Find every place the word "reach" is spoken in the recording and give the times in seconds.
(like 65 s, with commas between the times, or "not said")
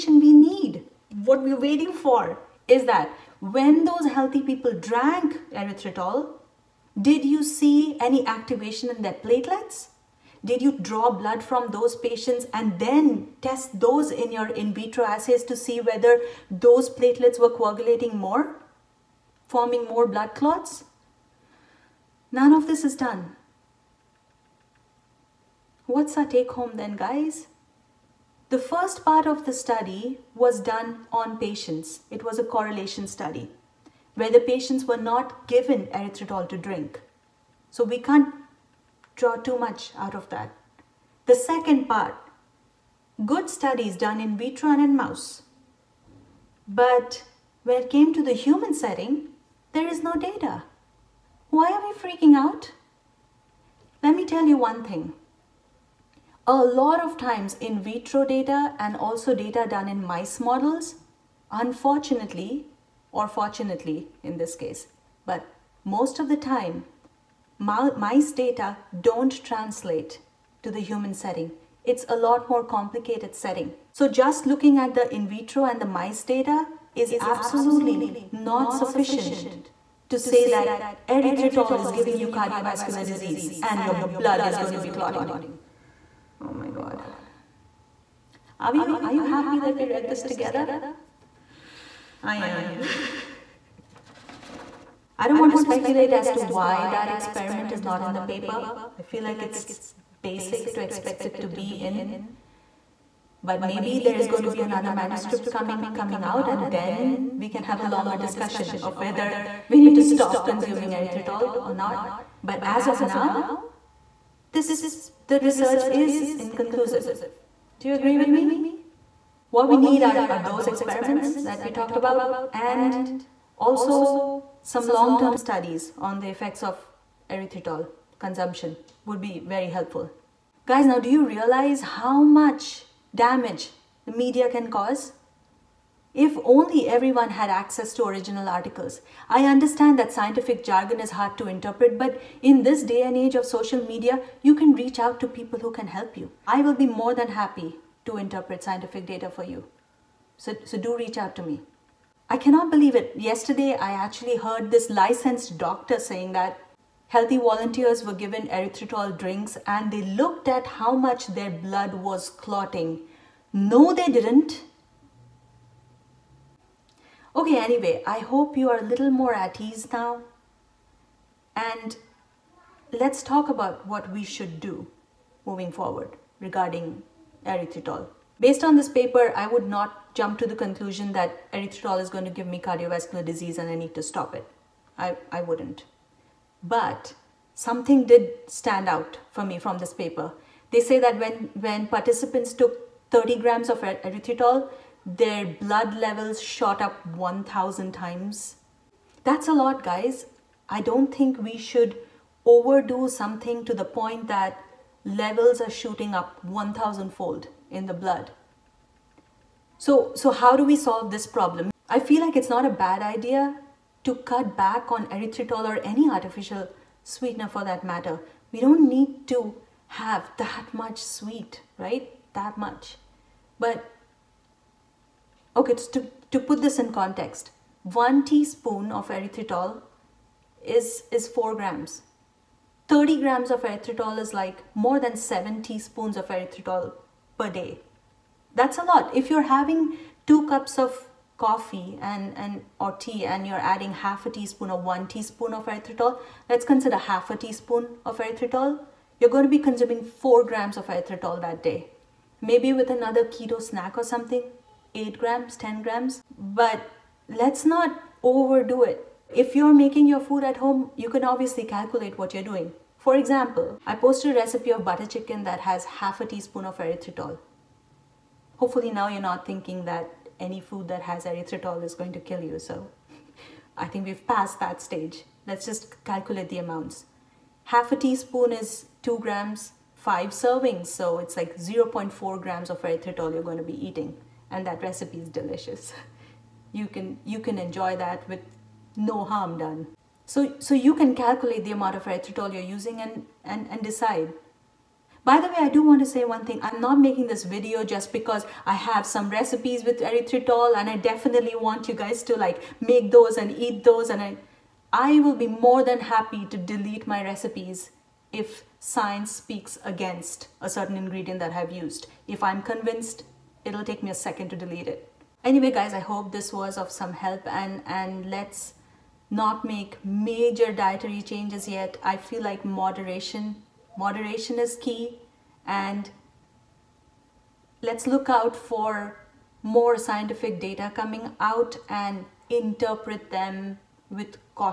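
144 s, 150 s.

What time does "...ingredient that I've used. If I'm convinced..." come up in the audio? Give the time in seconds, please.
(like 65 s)
310 s.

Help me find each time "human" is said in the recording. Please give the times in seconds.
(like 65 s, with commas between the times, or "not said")
48 s, 70 s.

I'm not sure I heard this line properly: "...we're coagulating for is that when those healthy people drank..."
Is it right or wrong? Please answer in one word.
wrong.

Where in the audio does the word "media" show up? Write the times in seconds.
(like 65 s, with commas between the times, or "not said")
134 s, 143 s.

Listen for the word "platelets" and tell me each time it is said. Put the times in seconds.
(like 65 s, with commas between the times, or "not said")
9 s, 16 s.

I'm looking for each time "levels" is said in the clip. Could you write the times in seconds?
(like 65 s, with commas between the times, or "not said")
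195 s, 205 s.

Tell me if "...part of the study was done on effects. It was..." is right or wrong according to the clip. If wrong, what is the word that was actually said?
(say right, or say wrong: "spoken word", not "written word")
wrong: "patients", not "effects".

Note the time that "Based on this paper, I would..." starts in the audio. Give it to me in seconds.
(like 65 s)
178 s.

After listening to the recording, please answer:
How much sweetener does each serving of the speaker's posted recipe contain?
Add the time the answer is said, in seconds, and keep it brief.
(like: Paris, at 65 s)
0.4 grams, at 281 s.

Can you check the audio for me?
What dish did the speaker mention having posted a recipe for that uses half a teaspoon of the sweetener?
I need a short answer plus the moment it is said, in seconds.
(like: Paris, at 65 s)
Butter chicken, at 264 s.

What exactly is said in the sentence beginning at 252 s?
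Maybe with another keto snack or something, 8 grams, 10 grams.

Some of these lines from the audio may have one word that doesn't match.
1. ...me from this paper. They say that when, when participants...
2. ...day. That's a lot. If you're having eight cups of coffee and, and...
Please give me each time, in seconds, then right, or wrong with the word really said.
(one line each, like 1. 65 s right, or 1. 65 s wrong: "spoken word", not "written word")
1. 189 s right
2. 237 s wrong: "two", not "eight".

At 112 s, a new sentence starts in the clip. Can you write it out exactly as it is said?
But as of now, this the research is inconclusive.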